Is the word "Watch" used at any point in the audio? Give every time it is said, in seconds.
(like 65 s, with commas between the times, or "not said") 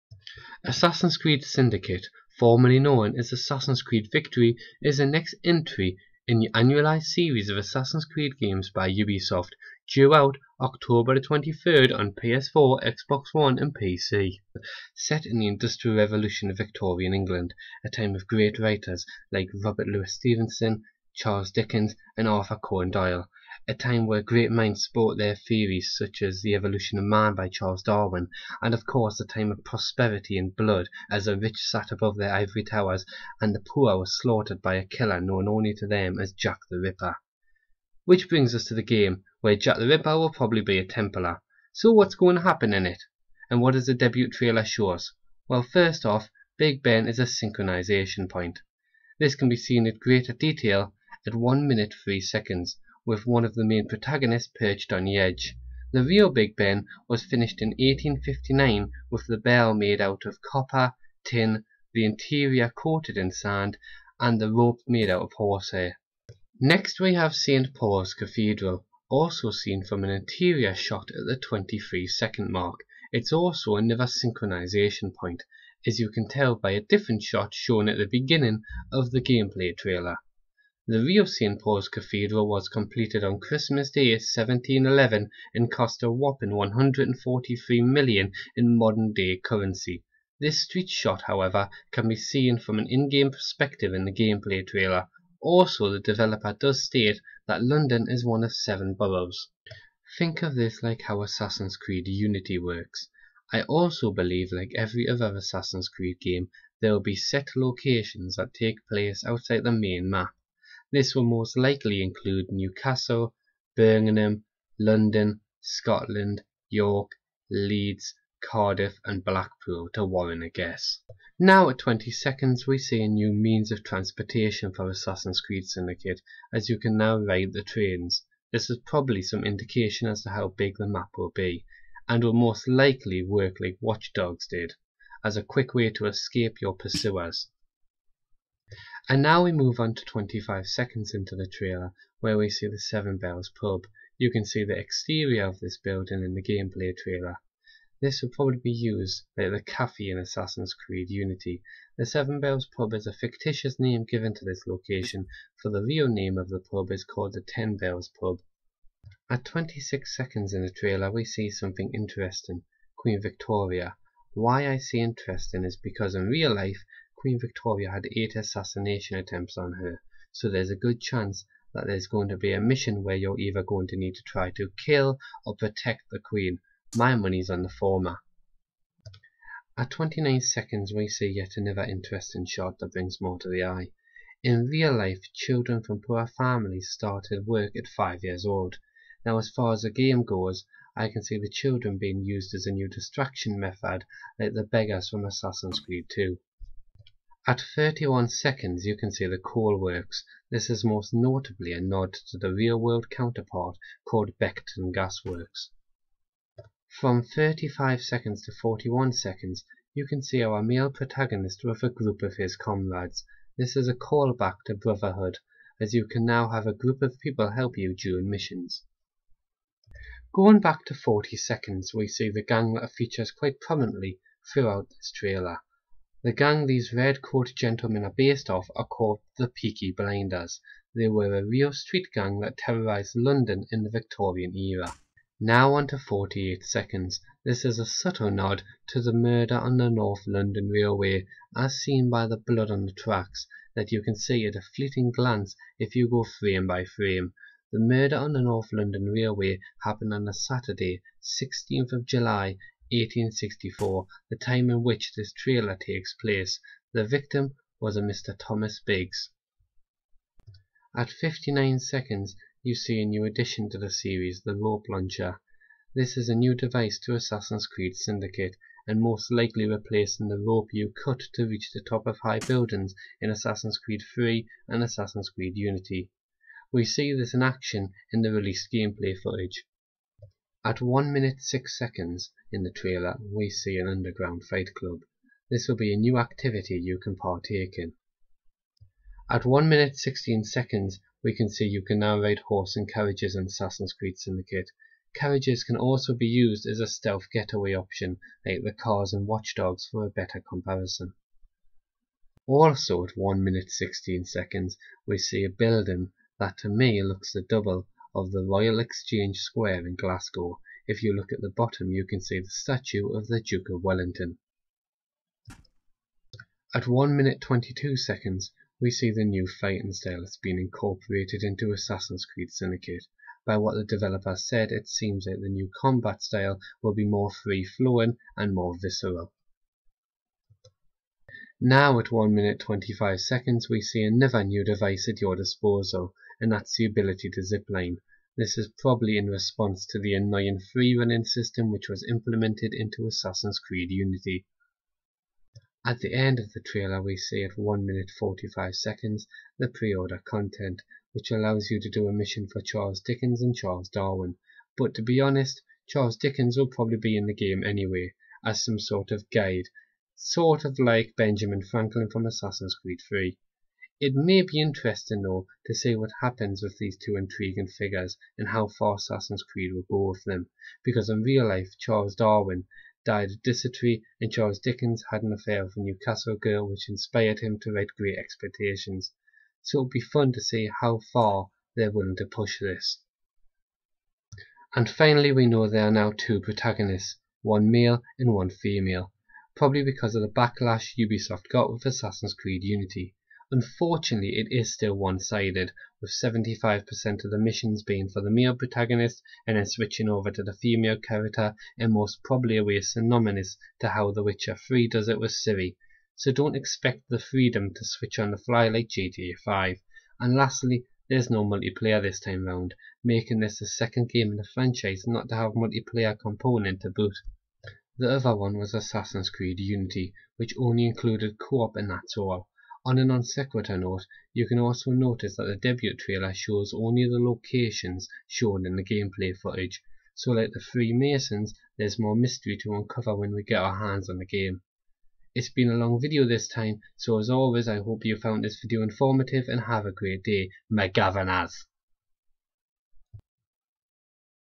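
133 s, 299 s.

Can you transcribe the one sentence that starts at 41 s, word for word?
So what's going to happen in it?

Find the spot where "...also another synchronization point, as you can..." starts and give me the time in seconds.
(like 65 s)
73 s.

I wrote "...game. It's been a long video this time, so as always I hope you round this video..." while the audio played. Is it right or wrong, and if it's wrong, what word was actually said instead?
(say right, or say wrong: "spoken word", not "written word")
wrong: "found", not "round".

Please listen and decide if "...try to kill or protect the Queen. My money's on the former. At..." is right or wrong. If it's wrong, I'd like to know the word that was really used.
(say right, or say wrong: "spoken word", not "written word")
right.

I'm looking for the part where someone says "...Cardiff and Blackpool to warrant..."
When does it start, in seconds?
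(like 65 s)
118 s.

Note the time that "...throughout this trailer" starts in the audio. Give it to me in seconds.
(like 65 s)
224 s.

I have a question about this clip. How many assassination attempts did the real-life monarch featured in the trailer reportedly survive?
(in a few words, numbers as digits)
8.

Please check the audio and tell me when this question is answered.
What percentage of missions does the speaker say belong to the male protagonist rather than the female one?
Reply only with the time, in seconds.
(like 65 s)
396 s.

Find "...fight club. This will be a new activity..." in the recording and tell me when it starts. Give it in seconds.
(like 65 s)
284 s.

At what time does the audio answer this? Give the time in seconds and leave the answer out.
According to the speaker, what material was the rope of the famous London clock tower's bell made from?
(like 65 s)
65 s.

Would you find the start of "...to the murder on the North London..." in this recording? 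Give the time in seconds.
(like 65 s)
238 s.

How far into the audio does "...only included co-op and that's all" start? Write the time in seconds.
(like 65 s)
420 s.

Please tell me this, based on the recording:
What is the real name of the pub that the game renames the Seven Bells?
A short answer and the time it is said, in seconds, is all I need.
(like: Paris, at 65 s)
Ten Bells pub, at 157 s.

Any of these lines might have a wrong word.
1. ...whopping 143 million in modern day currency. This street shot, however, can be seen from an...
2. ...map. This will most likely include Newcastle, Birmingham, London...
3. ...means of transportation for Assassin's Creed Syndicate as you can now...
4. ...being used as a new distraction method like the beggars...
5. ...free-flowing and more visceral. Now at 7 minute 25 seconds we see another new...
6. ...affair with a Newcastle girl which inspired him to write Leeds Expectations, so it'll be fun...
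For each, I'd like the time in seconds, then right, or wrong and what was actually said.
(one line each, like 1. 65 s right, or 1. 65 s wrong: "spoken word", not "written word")
1. 86 s right
2. 110 s right
3. 123 s right
4. 191 s right
5. 327 s wrong: "1", not "7"
6. 375 s wrong: "Great", not "Leeds".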